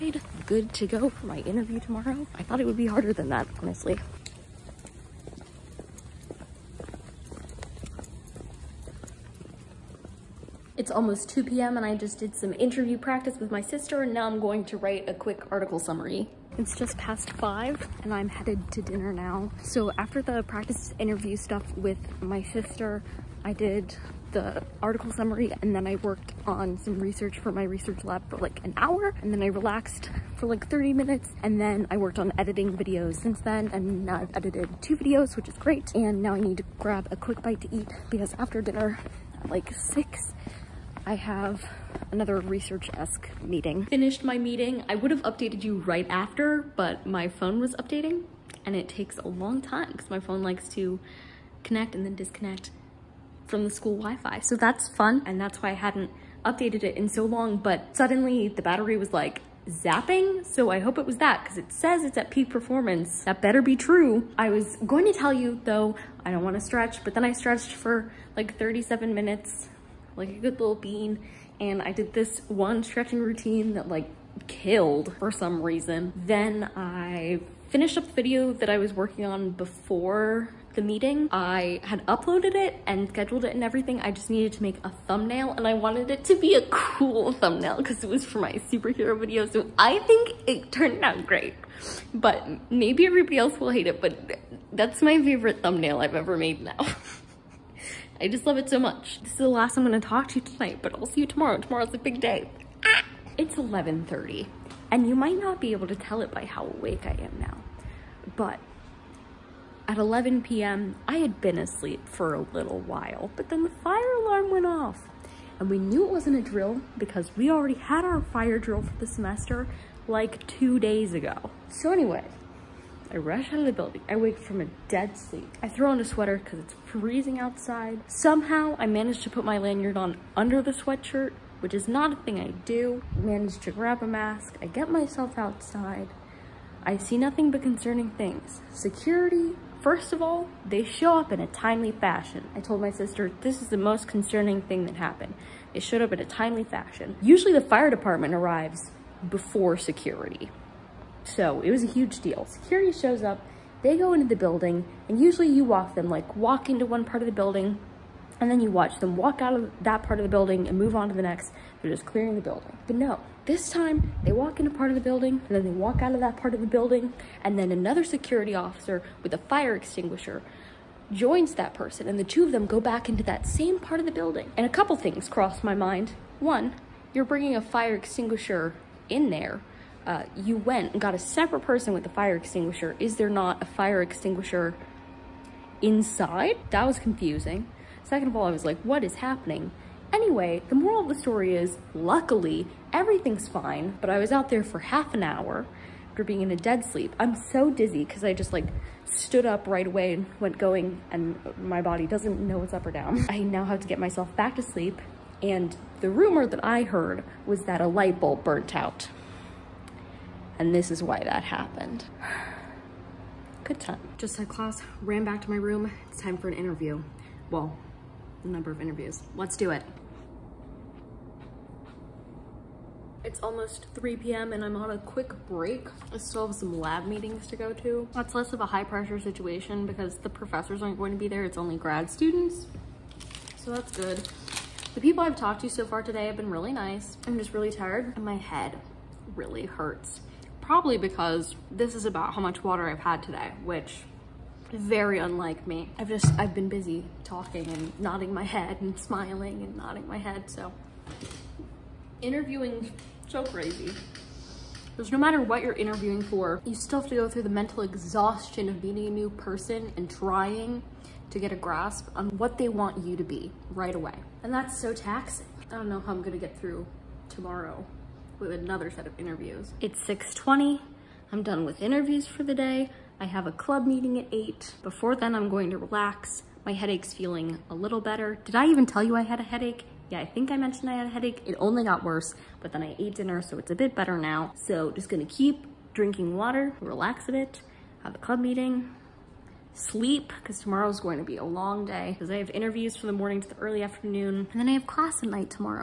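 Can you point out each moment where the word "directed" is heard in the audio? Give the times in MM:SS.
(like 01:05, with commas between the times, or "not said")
not said.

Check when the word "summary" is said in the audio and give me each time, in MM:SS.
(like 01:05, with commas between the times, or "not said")
00:15, 00:25.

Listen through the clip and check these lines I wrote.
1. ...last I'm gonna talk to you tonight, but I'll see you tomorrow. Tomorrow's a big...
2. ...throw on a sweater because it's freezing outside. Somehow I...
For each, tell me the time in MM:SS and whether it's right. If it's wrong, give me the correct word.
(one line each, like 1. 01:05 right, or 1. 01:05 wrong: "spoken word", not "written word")
1. 01:39 right
2. 02:05 right.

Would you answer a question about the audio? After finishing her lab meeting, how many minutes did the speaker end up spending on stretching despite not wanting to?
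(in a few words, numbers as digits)
37 minutes.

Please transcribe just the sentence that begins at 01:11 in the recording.
And I did this one stretching routine that like killed for some reason.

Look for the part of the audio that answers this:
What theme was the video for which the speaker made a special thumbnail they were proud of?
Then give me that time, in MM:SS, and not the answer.
01:28.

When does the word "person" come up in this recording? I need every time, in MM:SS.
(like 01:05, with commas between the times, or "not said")
02:51, 03:01, 04:19.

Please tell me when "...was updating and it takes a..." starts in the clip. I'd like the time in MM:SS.
00:47.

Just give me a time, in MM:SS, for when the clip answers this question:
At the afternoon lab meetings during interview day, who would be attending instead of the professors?
03:51.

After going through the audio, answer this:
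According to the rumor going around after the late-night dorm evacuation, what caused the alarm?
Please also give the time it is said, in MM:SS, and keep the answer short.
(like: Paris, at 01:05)
a light bulb burnt out, at 03:27.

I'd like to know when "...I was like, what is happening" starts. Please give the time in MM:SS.
03:08.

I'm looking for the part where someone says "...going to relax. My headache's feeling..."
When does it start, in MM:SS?
04:35.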